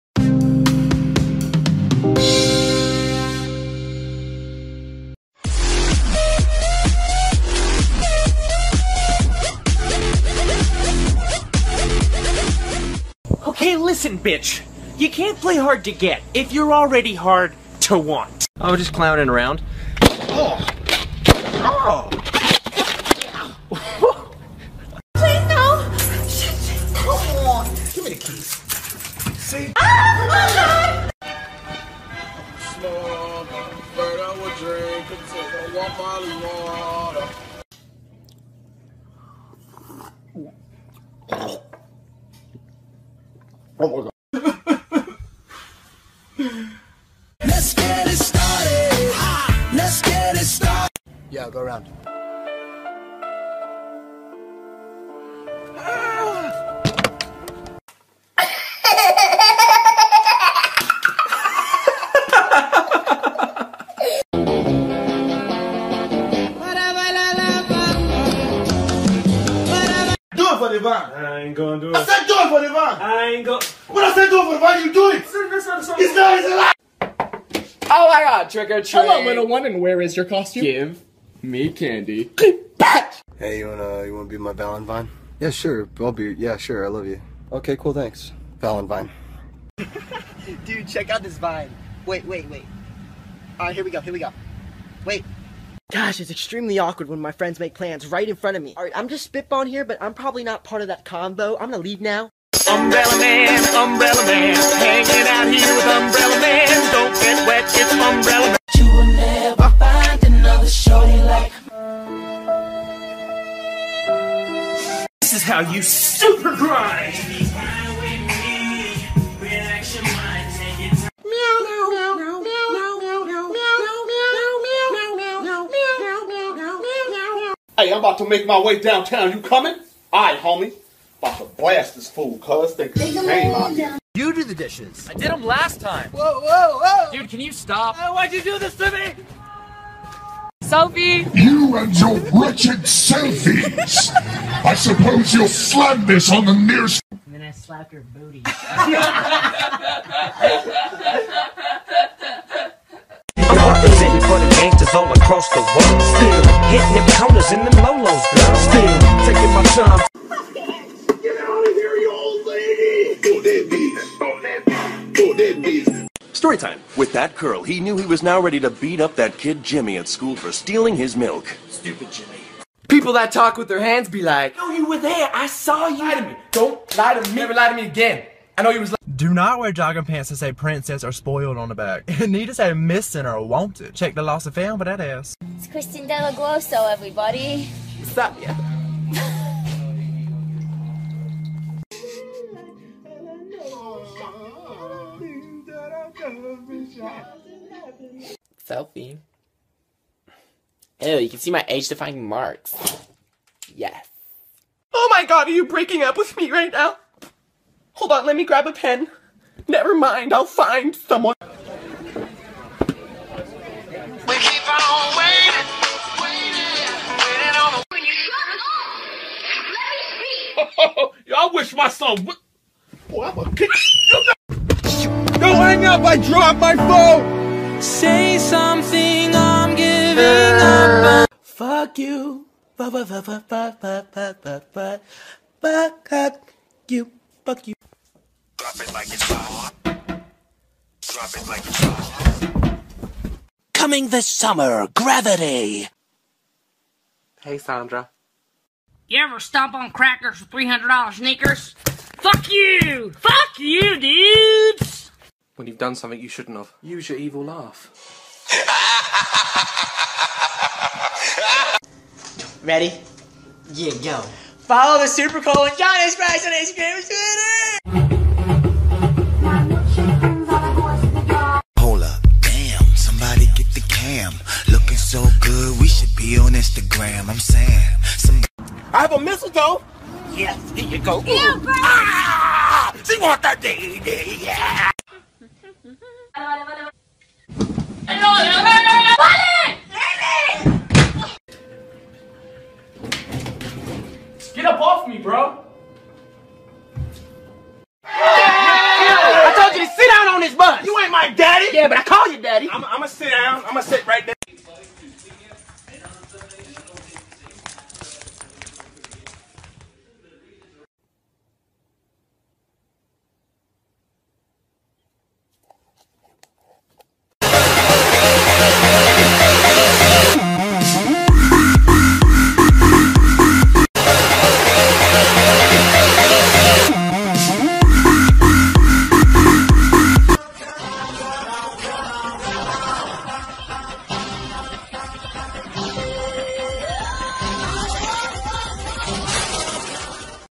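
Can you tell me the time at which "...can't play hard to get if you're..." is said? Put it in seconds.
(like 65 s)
15 s.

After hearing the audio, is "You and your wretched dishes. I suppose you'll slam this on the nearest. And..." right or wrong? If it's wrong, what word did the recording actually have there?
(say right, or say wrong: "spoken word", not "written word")
wrong: "selfies", not "dishes".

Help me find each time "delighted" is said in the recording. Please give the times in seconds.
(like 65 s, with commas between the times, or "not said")
not said.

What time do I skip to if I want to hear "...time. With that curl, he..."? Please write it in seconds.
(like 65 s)
166 s.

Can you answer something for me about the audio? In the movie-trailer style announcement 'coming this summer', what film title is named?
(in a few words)
Gravity.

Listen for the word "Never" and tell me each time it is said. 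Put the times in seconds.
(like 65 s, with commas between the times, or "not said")
177 s, 209 s.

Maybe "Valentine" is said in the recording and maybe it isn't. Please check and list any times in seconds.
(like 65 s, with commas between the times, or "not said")
84 s, 88 s.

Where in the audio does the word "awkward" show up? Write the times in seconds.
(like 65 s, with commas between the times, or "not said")
96 s.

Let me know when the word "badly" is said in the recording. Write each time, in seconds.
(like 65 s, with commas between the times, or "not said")
not said.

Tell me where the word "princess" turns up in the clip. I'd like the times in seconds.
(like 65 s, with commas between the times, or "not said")
180 s.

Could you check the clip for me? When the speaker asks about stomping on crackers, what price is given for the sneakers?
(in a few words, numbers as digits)
$300.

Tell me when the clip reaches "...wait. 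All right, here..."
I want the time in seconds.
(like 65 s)
92 s.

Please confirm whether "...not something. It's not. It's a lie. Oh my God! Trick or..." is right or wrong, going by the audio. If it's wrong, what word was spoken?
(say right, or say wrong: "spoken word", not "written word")
right.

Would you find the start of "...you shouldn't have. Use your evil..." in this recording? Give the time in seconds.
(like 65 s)
256 s.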